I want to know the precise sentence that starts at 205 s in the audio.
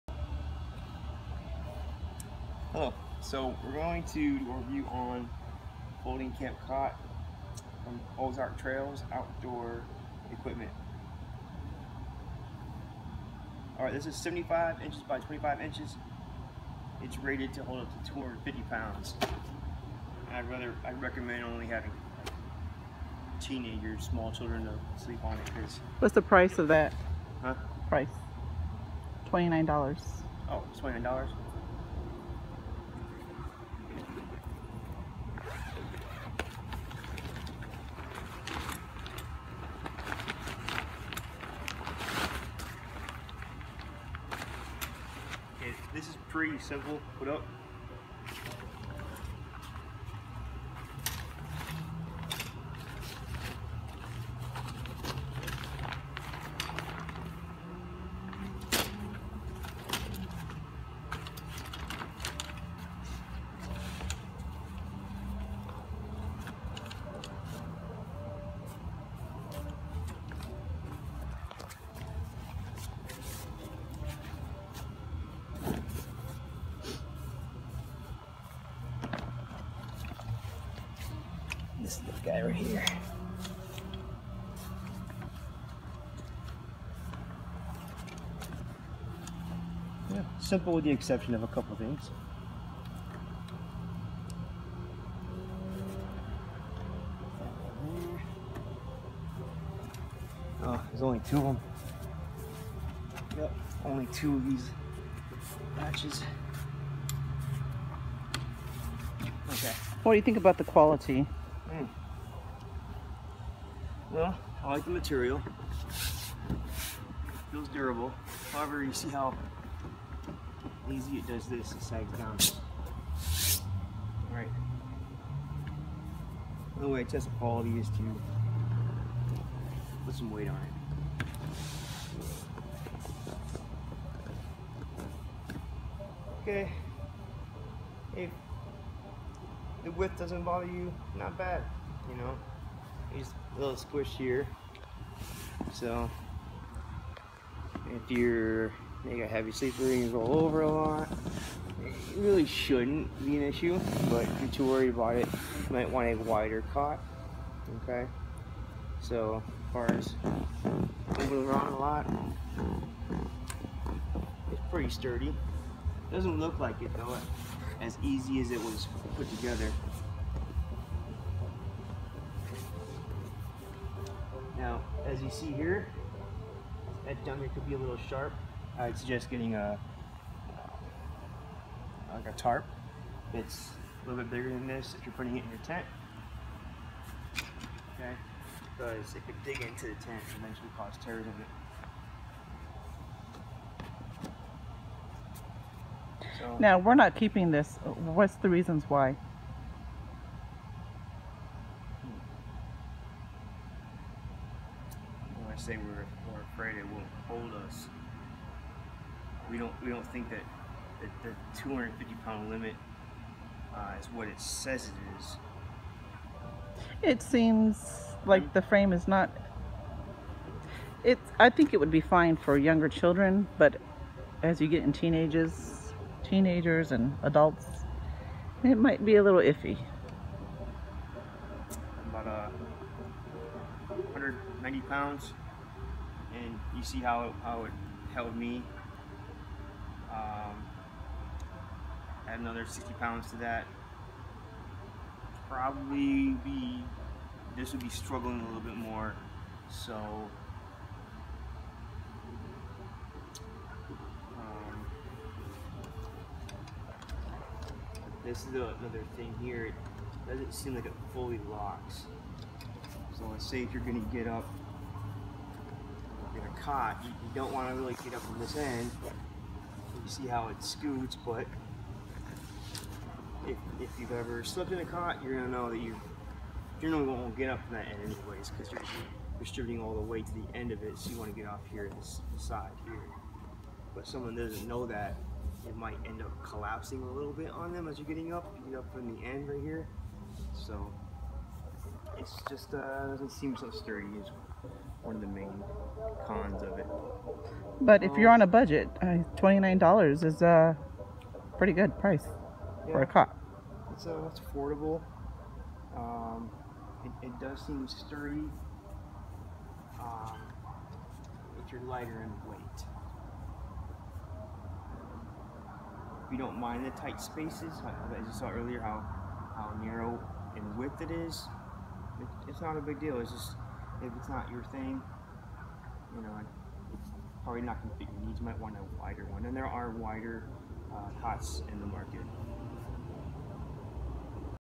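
say we're, we're afraid it won't hold us.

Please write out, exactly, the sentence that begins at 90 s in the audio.
Yeah, simple with the exception of a couple of things.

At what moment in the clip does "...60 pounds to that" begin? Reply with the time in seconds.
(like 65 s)
242 s.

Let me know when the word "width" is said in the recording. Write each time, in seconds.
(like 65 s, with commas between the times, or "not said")
139 s, 320 s.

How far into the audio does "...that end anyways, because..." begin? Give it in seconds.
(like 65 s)
277 s.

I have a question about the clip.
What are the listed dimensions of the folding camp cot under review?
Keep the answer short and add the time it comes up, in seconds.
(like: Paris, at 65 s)
75 by 25 inches, at 14 s.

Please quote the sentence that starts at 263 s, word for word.
So let's say if you're gonna get up get a cot.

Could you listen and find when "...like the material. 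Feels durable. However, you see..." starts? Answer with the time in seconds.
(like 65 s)
114 s.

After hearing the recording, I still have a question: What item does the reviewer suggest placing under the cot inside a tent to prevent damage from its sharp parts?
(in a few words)
a tarp.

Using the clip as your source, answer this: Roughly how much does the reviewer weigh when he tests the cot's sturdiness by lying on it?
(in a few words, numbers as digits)
190 pounds.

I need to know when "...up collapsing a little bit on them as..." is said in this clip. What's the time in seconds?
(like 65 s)
286 s.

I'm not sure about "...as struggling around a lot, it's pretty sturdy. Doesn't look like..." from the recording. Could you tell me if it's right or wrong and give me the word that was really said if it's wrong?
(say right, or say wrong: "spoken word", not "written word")
wrong: "moving", not "struggling".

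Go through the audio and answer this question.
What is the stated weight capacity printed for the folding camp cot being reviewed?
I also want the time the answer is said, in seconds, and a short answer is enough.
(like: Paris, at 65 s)
250 pounds, at 18 s.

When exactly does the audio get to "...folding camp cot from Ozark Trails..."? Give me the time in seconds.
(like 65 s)
6 s.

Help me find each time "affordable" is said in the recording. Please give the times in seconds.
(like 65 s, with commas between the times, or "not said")
304 s.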